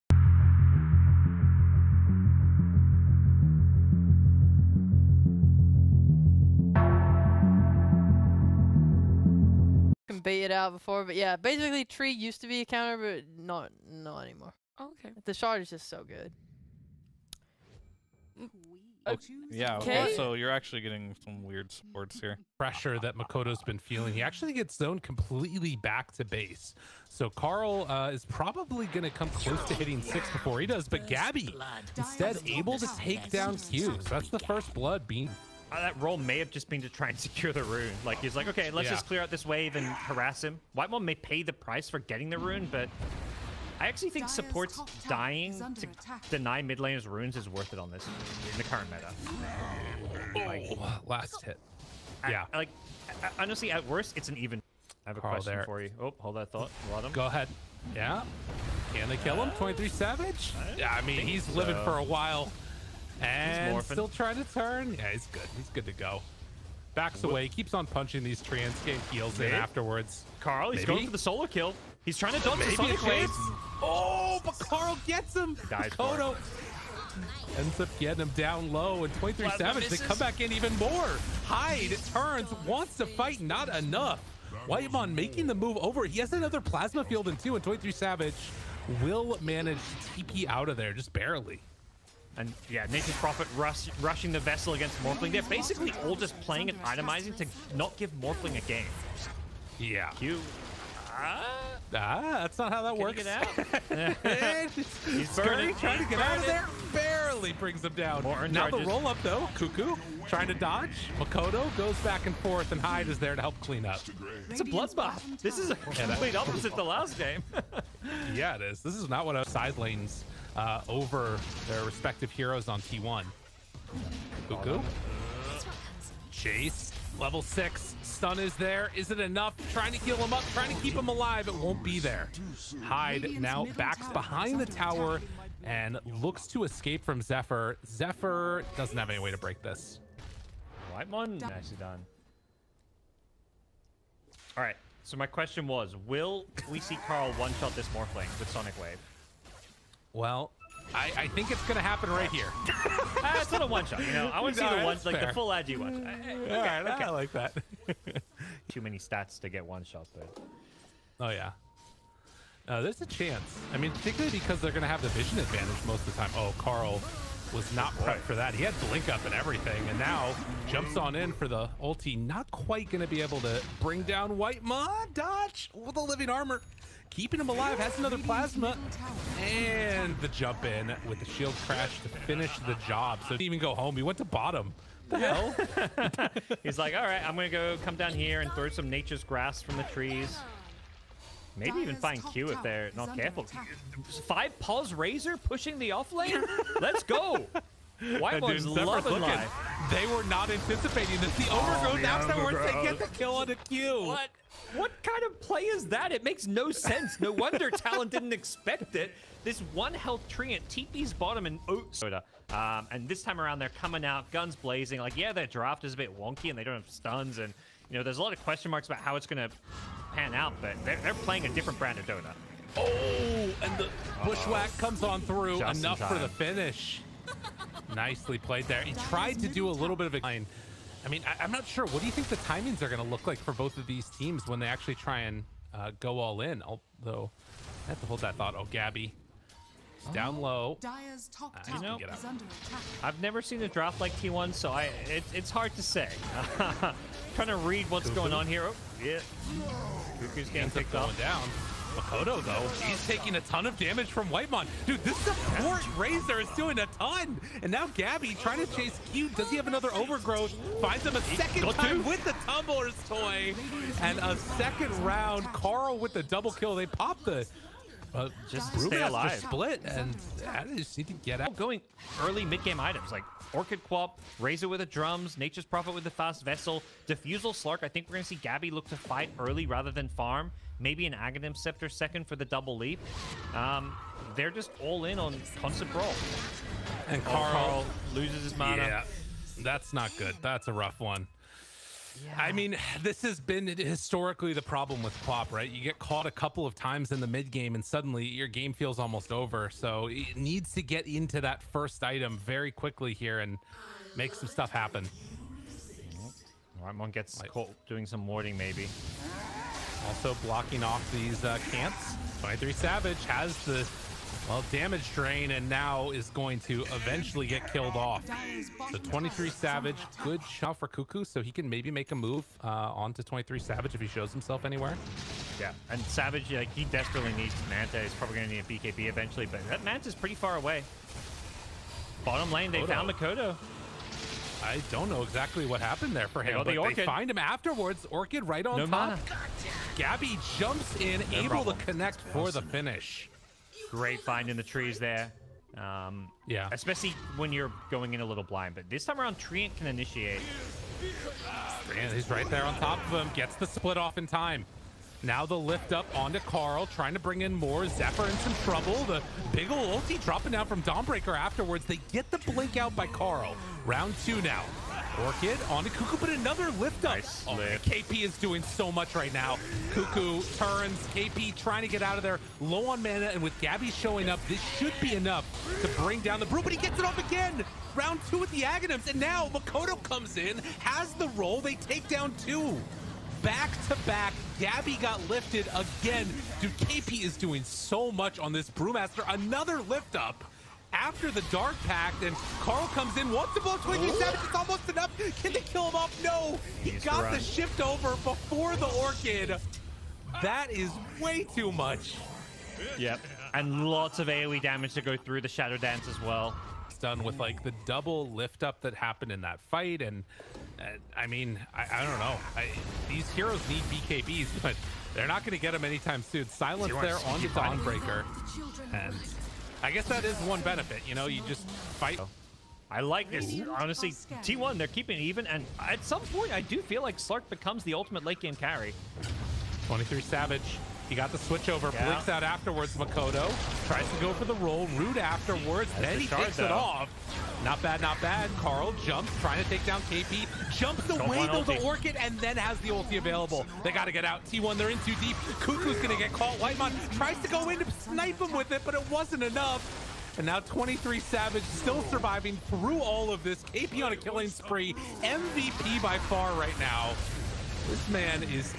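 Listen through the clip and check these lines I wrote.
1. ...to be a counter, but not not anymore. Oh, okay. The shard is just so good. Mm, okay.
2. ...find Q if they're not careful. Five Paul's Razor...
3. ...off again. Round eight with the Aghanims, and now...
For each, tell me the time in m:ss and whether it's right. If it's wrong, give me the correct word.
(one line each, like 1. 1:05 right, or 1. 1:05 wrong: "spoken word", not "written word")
1. 0:12 right
2. 3:11 right
3. 6:17 wrong: "two", not "eight".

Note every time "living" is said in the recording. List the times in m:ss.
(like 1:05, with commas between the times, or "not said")
1:01, 2:56.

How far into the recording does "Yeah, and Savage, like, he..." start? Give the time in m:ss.
5:25.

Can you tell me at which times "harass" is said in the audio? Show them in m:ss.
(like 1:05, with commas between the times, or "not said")
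0:39.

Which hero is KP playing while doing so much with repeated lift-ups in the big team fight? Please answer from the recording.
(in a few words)
Brewmaster.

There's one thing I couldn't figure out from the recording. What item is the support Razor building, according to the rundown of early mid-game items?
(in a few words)
Drums.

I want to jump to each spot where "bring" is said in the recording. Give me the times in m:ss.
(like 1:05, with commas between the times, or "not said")
1:47, 2:53, 5:57, 6:16.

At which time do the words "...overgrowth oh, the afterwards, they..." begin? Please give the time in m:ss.
3:21.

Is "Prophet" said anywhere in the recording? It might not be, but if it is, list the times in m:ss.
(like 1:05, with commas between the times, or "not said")
1:33, 4:35.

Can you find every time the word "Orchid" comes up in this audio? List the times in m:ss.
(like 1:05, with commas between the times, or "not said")
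4:33, 5:38, 6:05, 6:38, 7:21.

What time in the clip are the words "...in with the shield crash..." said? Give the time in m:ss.
3:00.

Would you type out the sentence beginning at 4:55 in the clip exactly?
You get caught a couple of times in the mid game, and suddenly your game feels almost over.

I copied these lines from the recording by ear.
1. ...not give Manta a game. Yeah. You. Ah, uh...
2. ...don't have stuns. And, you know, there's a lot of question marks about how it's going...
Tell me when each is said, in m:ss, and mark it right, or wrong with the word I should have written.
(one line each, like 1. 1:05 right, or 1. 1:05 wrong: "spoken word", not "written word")
1. 1:37 wrong: "Morphling", not "Manta"
2. 3:36 right.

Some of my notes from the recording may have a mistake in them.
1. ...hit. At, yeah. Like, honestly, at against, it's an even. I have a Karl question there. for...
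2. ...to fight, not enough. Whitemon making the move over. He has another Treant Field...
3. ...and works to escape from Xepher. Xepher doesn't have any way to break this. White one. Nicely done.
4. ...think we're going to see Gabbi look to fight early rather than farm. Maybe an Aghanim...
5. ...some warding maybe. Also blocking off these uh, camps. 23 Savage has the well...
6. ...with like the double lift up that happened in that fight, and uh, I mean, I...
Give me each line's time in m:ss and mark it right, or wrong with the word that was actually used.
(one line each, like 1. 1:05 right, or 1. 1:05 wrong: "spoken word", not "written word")
1. 0:51 wrong: "worst", not "against"
2. 1:22 wrong: "Plasma", not "Treant"
3. 2:15 wrong: "looks", not "works"
4. 4:37 right
5. 5:08 right
6. 6:47 right.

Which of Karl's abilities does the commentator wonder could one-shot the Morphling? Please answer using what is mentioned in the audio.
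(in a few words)
Sonic Wave.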